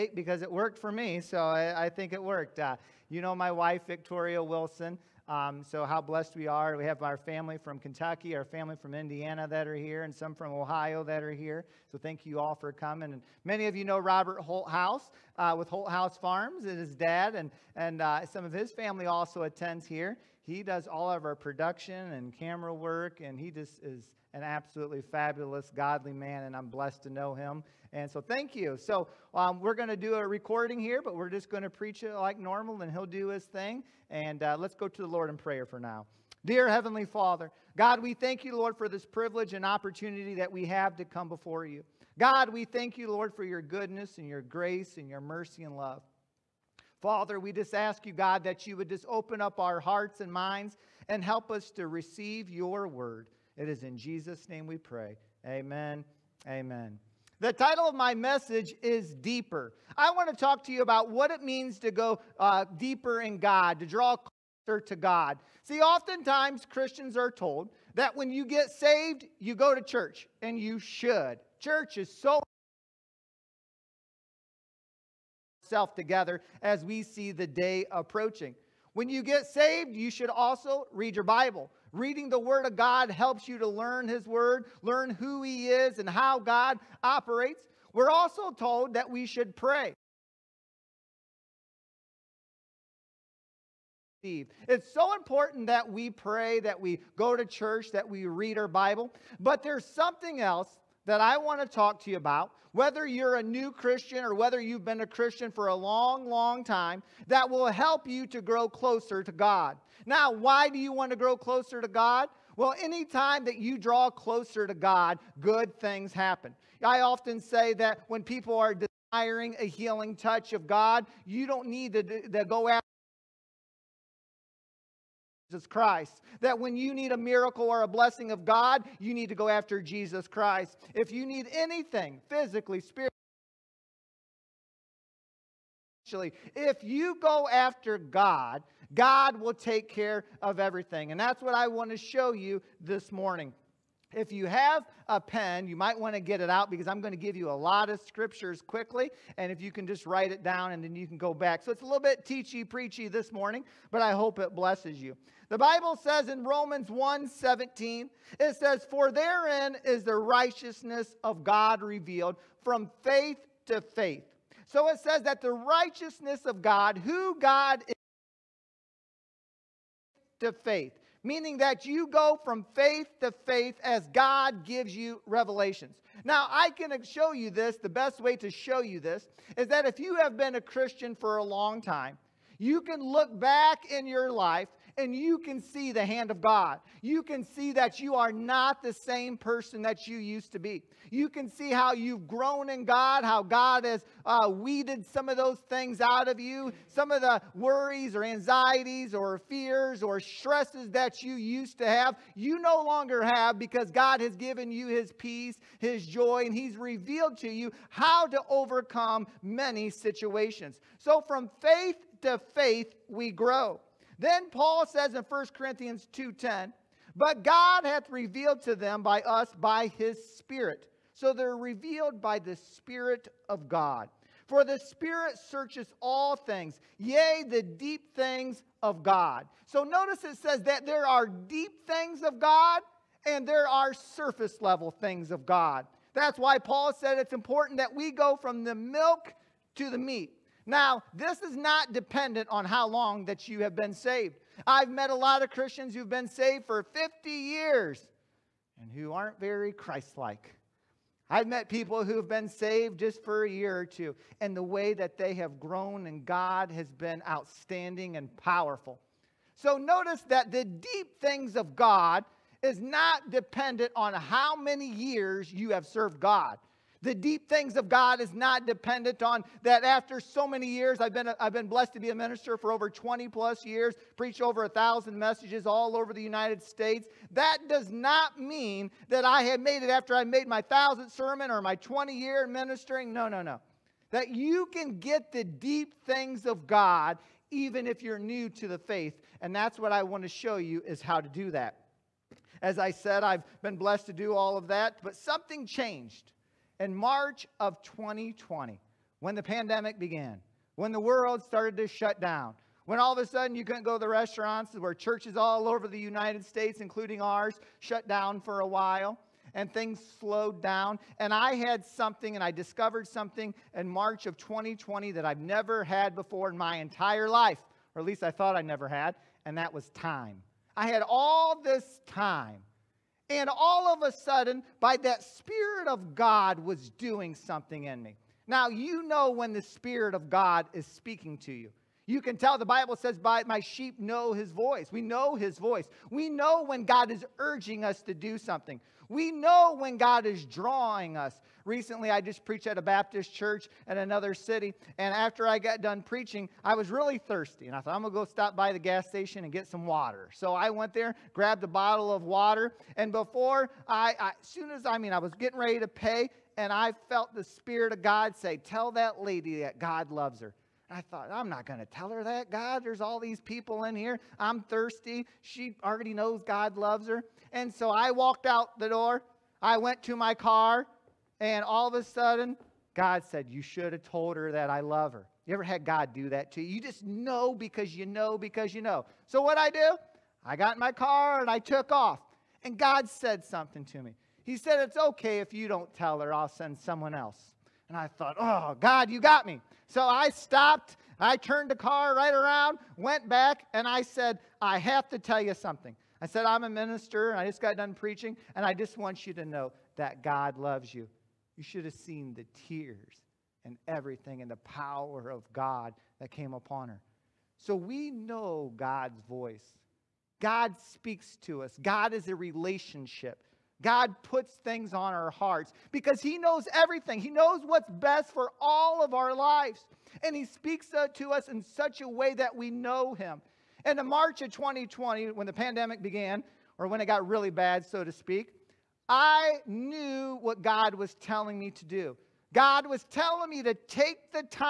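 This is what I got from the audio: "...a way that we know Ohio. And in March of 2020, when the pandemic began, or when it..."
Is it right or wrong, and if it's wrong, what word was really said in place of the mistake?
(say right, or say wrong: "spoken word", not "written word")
wrong: "Him", not "Ohio".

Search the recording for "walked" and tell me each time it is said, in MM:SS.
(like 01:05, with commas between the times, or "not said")
06:08.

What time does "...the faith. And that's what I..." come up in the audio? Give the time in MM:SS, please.
04:48.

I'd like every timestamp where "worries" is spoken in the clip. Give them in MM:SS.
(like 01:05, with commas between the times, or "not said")
03:17.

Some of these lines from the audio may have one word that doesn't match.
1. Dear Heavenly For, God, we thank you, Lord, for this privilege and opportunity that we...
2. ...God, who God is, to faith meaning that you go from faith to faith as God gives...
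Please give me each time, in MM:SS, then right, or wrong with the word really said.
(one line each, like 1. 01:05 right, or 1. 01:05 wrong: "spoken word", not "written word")
1. 00:36 wrong: "Father", not "For"
2. 02:46 right.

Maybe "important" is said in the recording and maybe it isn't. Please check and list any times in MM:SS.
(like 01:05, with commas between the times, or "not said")
01:35, 03:57.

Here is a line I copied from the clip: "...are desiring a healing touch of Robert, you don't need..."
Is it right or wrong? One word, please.
wrong.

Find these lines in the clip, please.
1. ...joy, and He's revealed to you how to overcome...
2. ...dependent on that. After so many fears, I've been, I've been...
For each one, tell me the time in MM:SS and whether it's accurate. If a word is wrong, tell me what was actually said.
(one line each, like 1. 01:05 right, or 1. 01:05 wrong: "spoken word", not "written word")
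1. 03:26 right
2. 04:28 wrong: "years", not "fears".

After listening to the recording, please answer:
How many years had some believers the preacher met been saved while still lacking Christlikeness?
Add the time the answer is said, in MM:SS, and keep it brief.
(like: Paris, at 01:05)
50, at 04:06.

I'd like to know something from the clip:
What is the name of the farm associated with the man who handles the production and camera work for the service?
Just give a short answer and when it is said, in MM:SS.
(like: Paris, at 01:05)
Holthouse Farms, at 00:15.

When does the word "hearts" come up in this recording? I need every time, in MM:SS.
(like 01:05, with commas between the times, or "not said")
00:49, 06:55.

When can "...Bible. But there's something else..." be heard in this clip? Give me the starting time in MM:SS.
01:38.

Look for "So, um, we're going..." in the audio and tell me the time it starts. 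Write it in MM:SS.
00:28.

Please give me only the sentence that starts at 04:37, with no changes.
That does not mean that I had made it after I made my thousandth sermon or my 20 year ministering.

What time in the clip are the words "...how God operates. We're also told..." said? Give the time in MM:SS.
01:26.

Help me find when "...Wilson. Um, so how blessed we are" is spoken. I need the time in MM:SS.
00:04.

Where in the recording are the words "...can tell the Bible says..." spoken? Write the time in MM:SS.
05:32.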